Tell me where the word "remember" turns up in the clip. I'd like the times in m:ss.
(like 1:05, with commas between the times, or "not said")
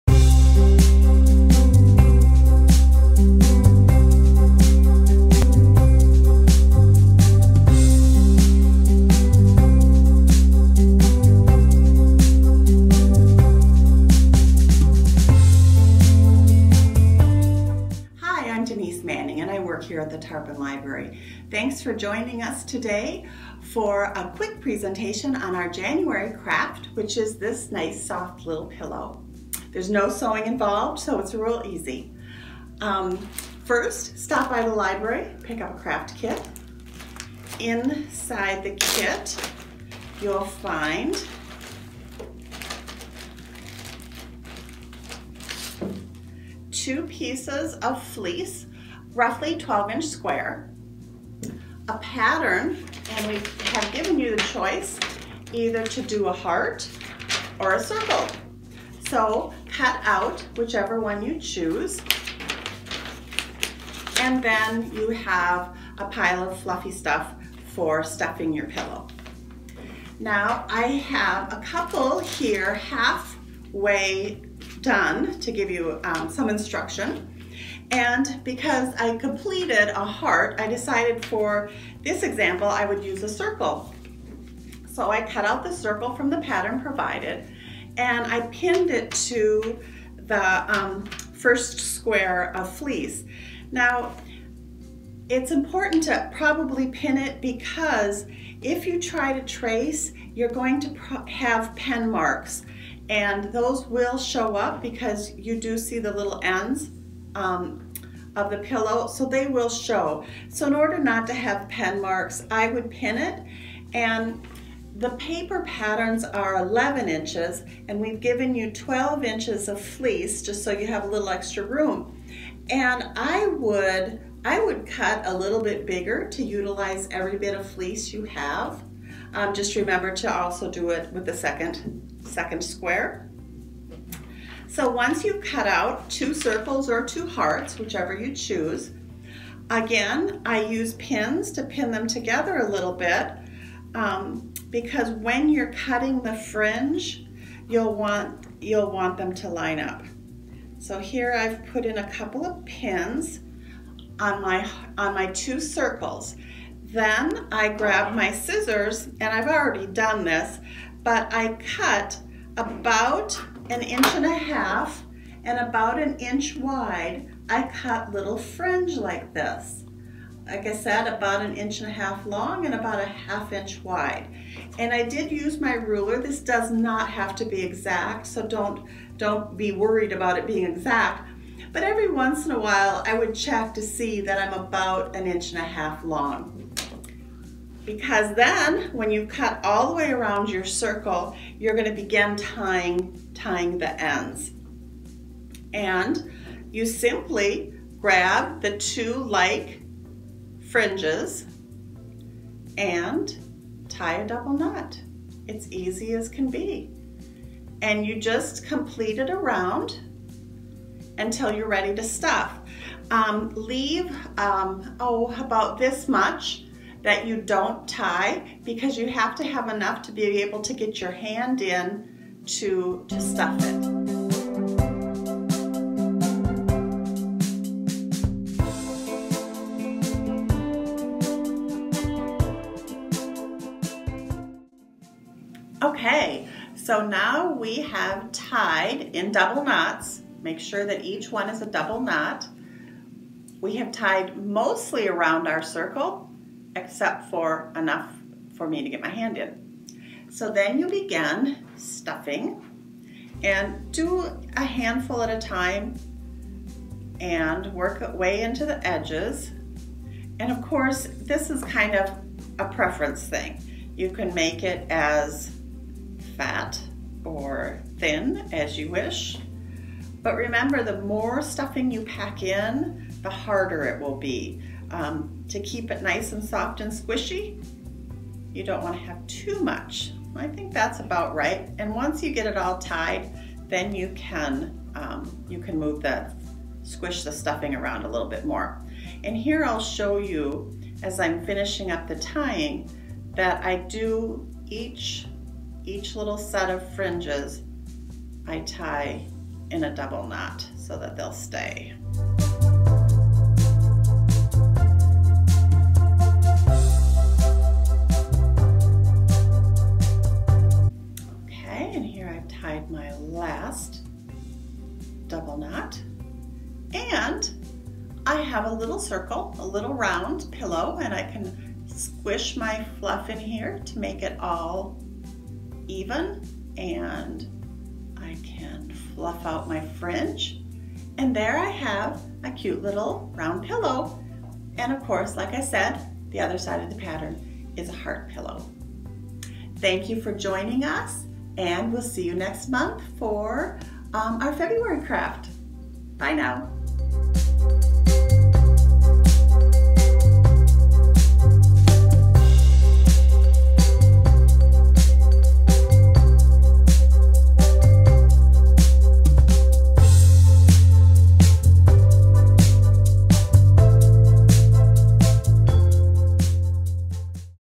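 2:09, 4:30.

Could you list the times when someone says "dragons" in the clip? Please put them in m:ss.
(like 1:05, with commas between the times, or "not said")
not said.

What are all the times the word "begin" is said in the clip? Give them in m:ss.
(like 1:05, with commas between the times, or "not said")
3:11, 4:10.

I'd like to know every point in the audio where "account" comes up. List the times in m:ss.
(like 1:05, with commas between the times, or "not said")
not said.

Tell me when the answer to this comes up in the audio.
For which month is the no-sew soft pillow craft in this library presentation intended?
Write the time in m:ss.
0:25.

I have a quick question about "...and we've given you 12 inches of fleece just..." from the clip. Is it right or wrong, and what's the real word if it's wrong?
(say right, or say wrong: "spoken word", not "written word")
right.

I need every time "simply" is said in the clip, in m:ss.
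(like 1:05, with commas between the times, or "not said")
3:16.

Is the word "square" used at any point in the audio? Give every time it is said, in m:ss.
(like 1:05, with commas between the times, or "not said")
0:50, 1:31, 2:12.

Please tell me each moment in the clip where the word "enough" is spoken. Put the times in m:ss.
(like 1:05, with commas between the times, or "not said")
3:39, 4:07.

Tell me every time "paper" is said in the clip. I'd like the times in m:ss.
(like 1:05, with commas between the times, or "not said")
1:55.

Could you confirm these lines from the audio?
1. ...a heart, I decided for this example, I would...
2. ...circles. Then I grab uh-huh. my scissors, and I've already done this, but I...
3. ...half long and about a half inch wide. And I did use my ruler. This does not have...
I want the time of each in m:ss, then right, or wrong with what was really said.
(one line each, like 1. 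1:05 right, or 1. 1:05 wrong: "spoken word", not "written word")
1. 1:19 right
2. 2:35 right
3. 2:51 right.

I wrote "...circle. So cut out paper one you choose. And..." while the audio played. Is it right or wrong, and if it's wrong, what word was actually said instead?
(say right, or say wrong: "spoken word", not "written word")
wrong: "whichever", not "paper".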